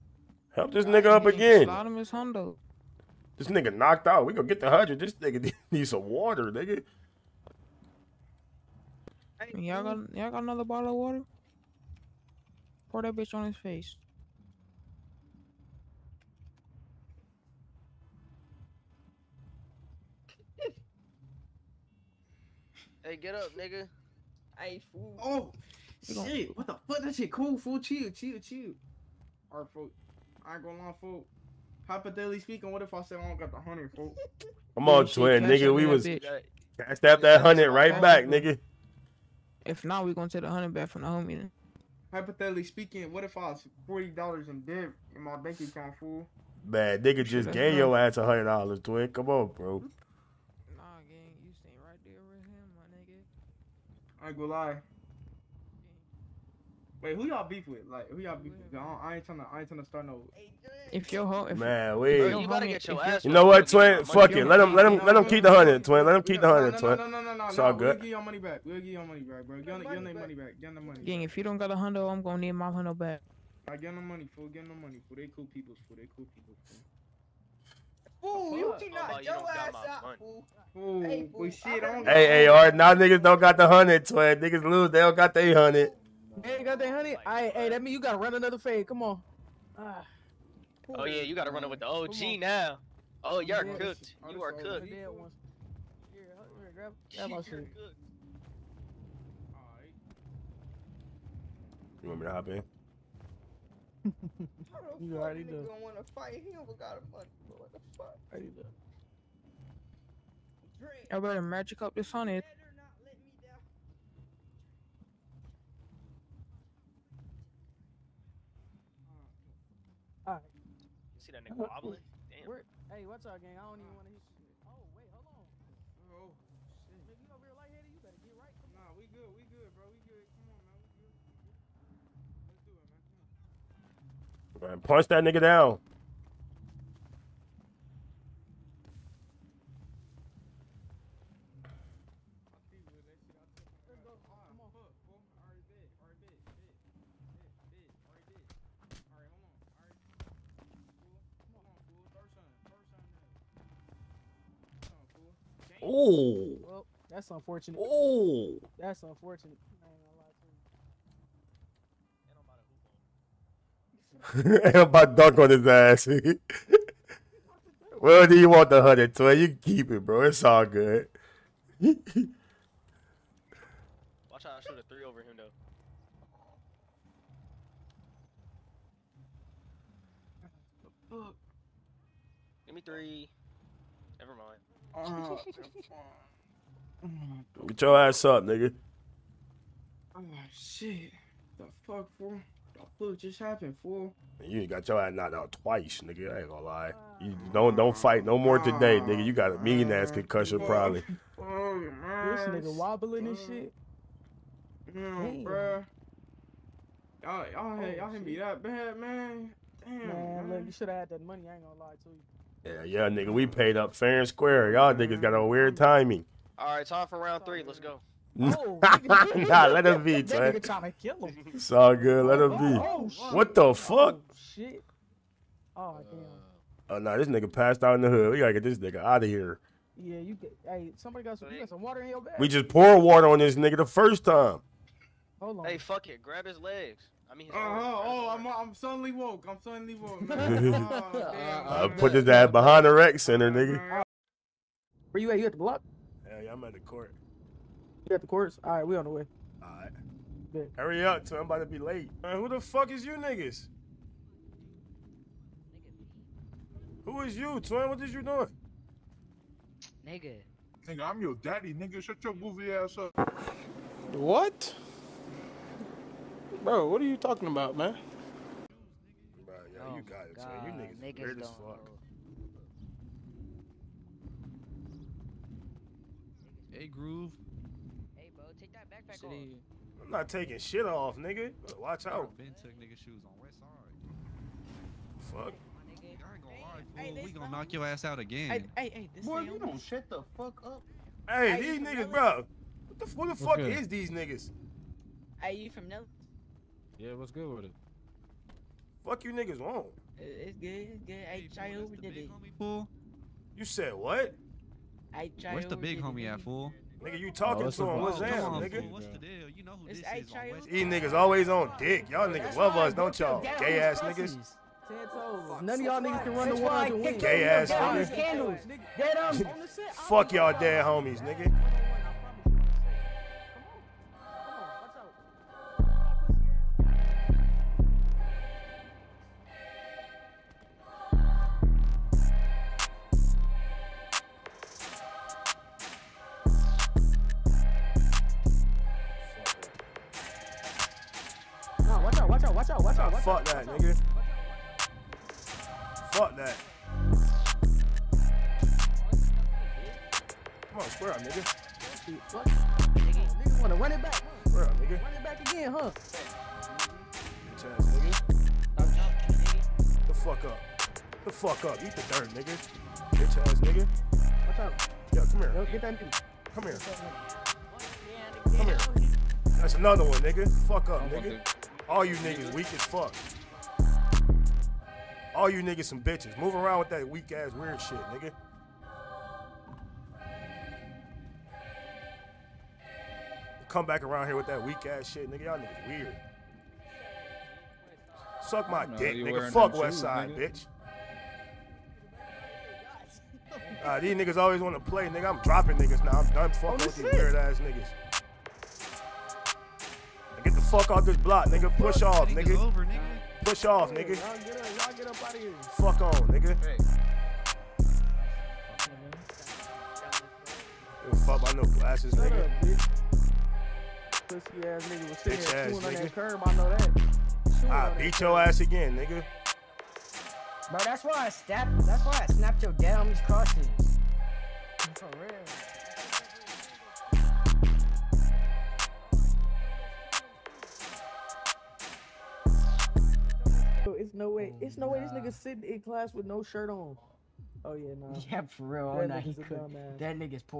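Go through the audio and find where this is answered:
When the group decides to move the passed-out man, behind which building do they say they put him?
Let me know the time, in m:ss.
4:02.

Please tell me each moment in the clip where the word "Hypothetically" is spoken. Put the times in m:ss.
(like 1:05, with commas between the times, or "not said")
0:31, 0:42.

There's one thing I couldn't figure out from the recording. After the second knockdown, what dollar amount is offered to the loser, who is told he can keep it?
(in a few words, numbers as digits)
120.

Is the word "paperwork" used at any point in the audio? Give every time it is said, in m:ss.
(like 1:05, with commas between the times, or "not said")
not said.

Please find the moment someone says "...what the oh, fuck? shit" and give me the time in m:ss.
3:43.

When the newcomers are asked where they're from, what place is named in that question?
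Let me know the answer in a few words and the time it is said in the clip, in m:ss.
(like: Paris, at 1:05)
Nelly, at 4:55.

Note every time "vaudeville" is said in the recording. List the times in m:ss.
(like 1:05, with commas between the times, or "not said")
not said.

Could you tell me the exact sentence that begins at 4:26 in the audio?
Bro, what are you talking about, man?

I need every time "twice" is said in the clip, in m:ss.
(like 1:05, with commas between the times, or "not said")
3:15.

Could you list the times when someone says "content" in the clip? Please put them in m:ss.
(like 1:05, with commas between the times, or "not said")
not said.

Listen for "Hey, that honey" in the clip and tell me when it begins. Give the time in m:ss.
1:26.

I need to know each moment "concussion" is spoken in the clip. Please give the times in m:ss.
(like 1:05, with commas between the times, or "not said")
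3:20.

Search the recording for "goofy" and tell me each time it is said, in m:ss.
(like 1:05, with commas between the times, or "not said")
4:22.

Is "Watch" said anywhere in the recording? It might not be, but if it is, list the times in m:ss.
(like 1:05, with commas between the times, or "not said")
2:51, 4:41.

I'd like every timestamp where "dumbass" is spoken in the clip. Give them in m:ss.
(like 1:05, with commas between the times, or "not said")
7:19.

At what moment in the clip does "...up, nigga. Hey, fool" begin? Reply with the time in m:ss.
0:23.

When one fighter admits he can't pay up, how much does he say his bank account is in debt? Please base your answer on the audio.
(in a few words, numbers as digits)
$40.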